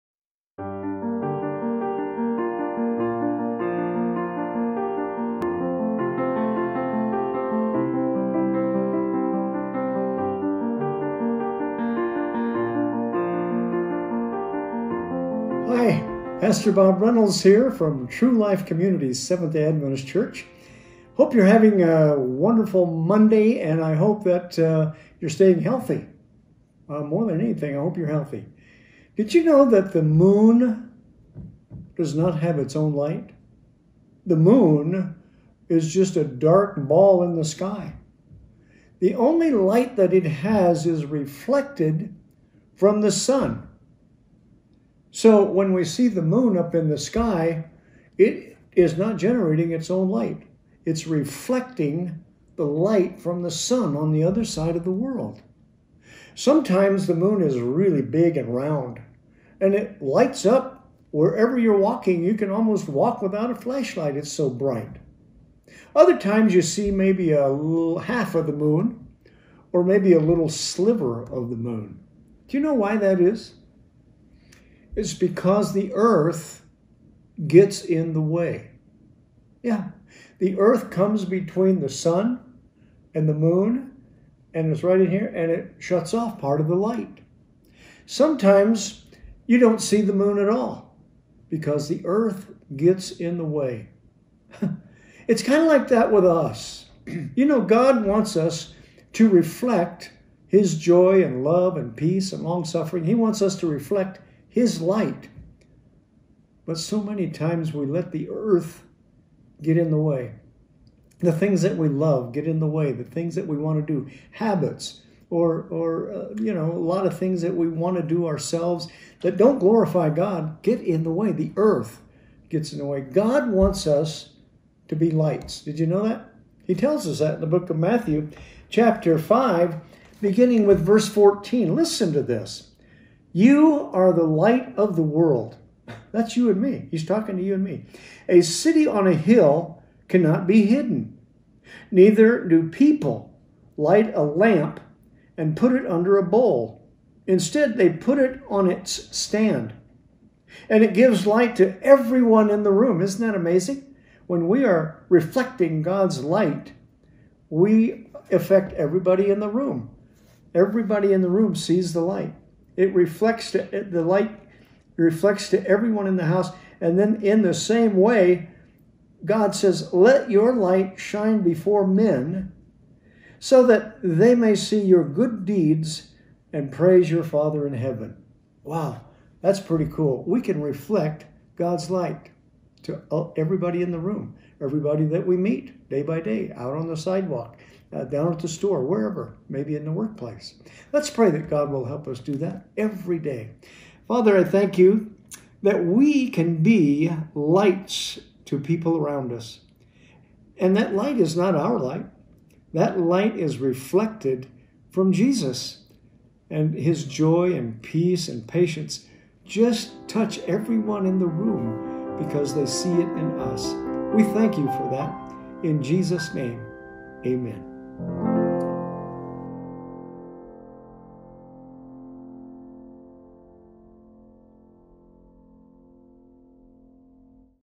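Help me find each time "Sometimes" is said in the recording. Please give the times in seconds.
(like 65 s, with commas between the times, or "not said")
56 s, 88 s.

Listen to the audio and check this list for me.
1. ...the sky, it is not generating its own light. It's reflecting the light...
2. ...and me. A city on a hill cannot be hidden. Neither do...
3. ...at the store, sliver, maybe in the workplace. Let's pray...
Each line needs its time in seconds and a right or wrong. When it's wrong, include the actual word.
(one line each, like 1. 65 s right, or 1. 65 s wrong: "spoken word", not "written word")
1. 46 s right
2. 137 s right
3. 188 s wrong: "wherever", not "sliver".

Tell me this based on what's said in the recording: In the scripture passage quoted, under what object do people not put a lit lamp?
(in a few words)
A bowl.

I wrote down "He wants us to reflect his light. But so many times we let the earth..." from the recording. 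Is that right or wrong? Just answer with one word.
right.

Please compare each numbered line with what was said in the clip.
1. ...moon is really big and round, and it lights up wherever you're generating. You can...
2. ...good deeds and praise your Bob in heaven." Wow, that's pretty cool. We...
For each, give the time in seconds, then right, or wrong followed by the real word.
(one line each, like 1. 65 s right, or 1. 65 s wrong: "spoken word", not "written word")
1. 57 s wrong: "walking", not "generating"
2. 175 s wrong: "Father", not "Bob".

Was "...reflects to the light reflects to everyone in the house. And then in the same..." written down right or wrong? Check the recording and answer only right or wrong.
right.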